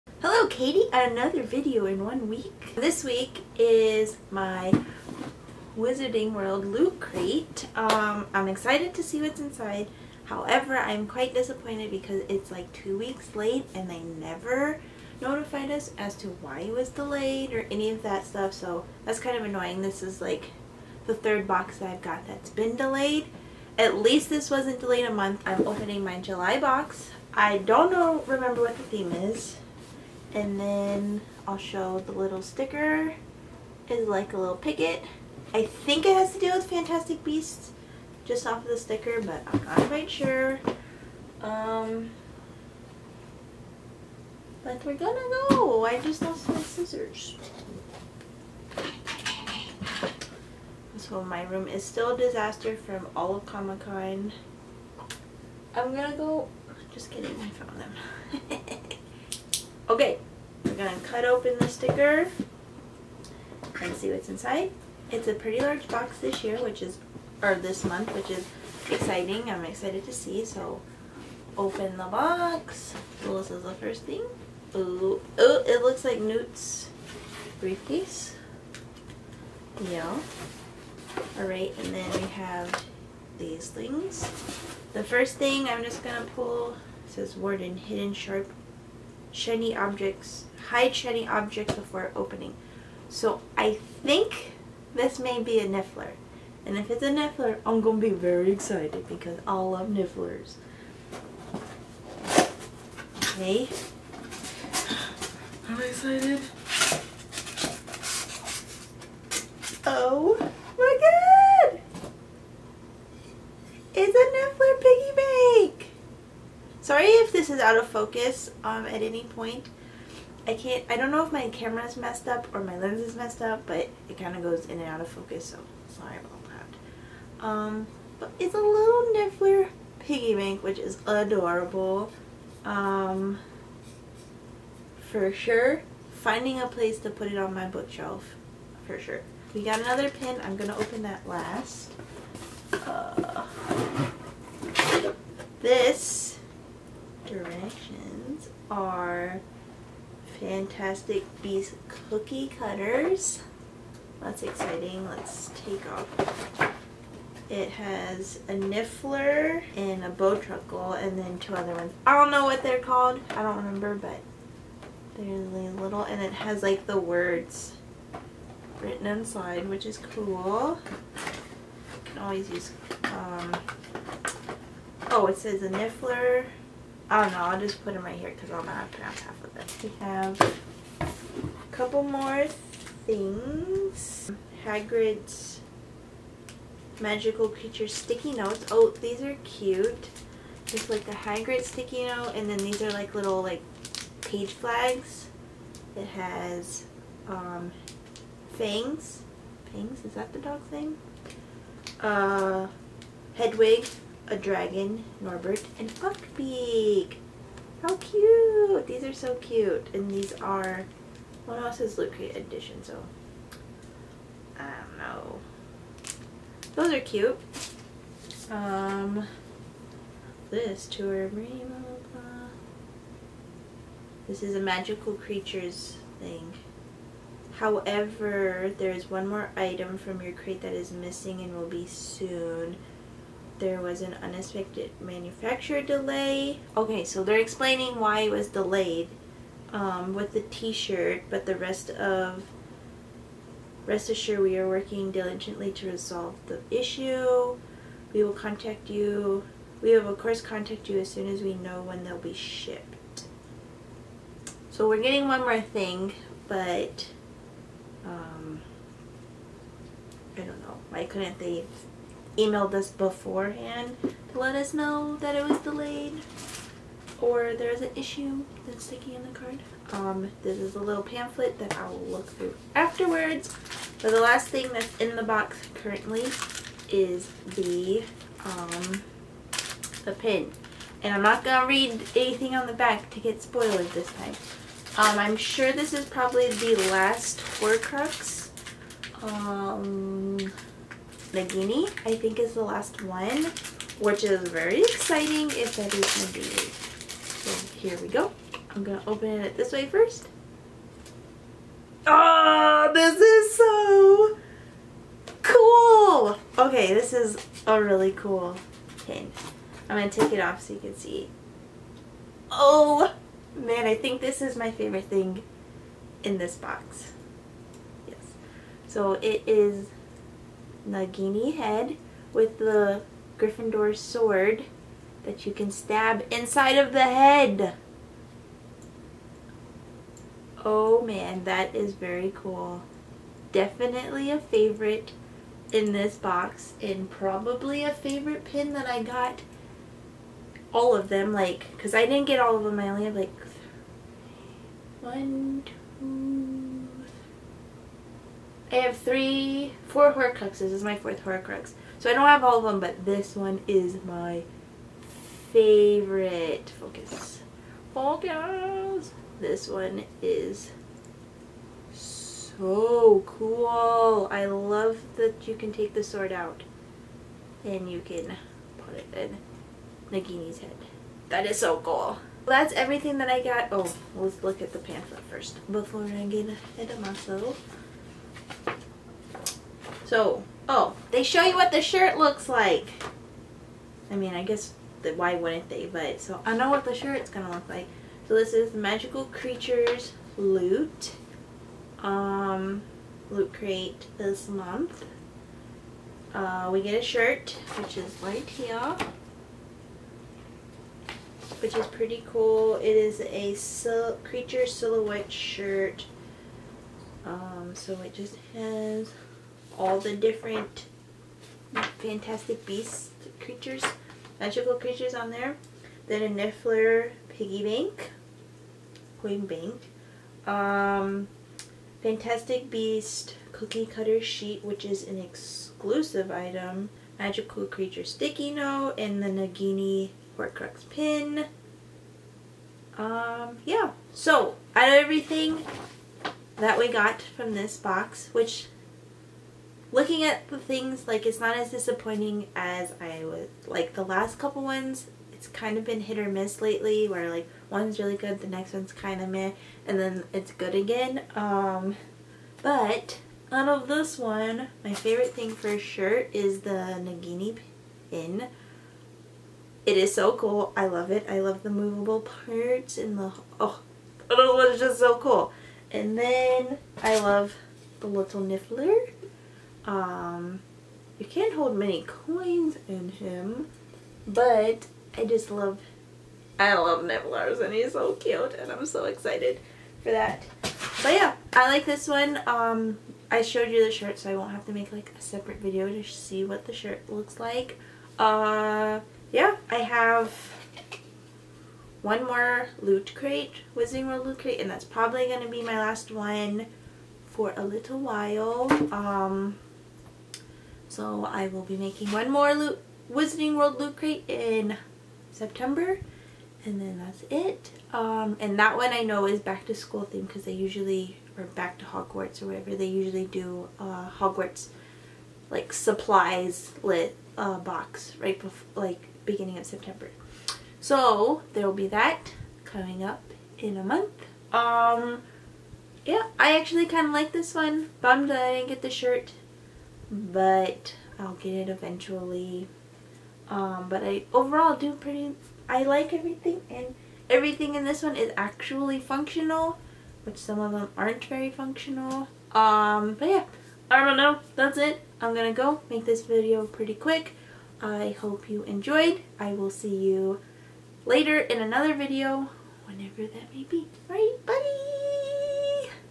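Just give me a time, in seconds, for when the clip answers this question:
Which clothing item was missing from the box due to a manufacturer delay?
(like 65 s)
240 s.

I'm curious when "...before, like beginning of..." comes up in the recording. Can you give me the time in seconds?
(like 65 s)
518 s.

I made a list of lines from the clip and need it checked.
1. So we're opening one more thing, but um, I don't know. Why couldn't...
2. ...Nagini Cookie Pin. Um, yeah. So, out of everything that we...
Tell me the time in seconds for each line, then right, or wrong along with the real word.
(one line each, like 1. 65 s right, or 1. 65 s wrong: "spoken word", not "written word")
1. 254 s wrong: "getting", not "opening"
2. 429 s wrong: "Horcrux", not "Cookie".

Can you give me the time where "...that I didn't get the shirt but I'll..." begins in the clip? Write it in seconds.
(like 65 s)
528 s.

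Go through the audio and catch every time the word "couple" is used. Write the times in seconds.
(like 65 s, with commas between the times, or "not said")
181 s, 444 s.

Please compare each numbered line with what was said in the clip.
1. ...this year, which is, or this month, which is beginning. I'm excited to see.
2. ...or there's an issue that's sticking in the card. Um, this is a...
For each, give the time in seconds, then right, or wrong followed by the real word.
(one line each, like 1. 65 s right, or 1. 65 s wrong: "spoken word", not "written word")
1. 66 s wrong: "exciting", not "beginning"
2. 267 s right.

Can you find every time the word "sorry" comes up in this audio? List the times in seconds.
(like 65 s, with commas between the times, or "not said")
125 s.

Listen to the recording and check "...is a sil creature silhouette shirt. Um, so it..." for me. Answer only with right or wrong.
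right.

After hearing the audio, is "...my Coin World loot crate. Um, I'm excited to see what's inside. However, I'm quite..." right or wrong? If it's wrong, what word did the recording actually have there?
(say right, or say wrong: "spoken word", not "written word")
wrong: "Wizarding", not "Coin".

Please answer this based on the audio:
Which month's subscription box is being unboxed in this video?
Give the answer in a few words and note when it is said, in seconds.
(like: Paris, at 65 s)
July, at 26 s.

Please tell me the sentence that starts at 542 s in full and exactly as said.
Um, but yeah, I don't know, that's it.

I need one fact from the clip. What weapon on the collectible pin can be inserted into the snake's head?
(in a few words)
Gryffindor sword.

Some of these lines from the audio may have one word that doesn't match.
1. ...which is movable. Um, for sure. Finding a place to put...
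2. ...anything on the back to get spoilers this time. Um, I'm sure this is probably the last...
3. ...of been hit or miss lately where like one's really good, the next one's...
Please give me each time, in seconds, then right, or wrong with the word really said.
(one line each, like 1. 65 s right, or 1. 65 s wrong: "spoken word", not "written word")
1. 130 s wrong: "adorable", not "movable"
2. 282 s right
3. 445 s right.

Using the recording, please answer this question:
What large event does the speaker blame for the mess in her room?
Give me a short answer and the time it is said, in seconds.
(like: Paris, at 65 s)
Comic-Con, at 53 s.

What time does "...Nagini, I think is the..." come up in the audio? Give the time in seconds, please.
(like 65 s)
291 s.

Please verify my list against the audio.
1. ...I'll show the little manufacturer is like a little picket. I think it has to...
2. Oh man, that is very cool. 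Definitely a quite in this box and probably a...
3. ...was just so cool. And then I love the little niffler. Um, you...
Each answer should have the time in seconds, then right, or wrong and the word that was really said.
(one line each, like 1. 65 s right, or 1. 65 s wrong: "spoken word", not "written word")
1. 31 s wrong: "sticker", not "manufacturer"
2. 330 s wrong: "favorite", not "quite"
3. 464 s right.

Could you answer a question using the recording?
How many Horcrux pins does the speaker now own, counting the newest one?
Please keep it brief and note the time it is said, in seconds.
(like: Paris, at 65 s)
4, at 349 s.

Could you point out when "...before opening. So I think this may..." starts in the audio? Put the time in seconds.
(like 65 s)
91 s.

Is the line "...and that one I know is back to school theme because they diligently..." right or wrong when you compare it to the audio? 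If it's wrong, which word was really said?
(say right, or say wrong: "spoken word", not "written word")
wrong: "usually", not "diligently".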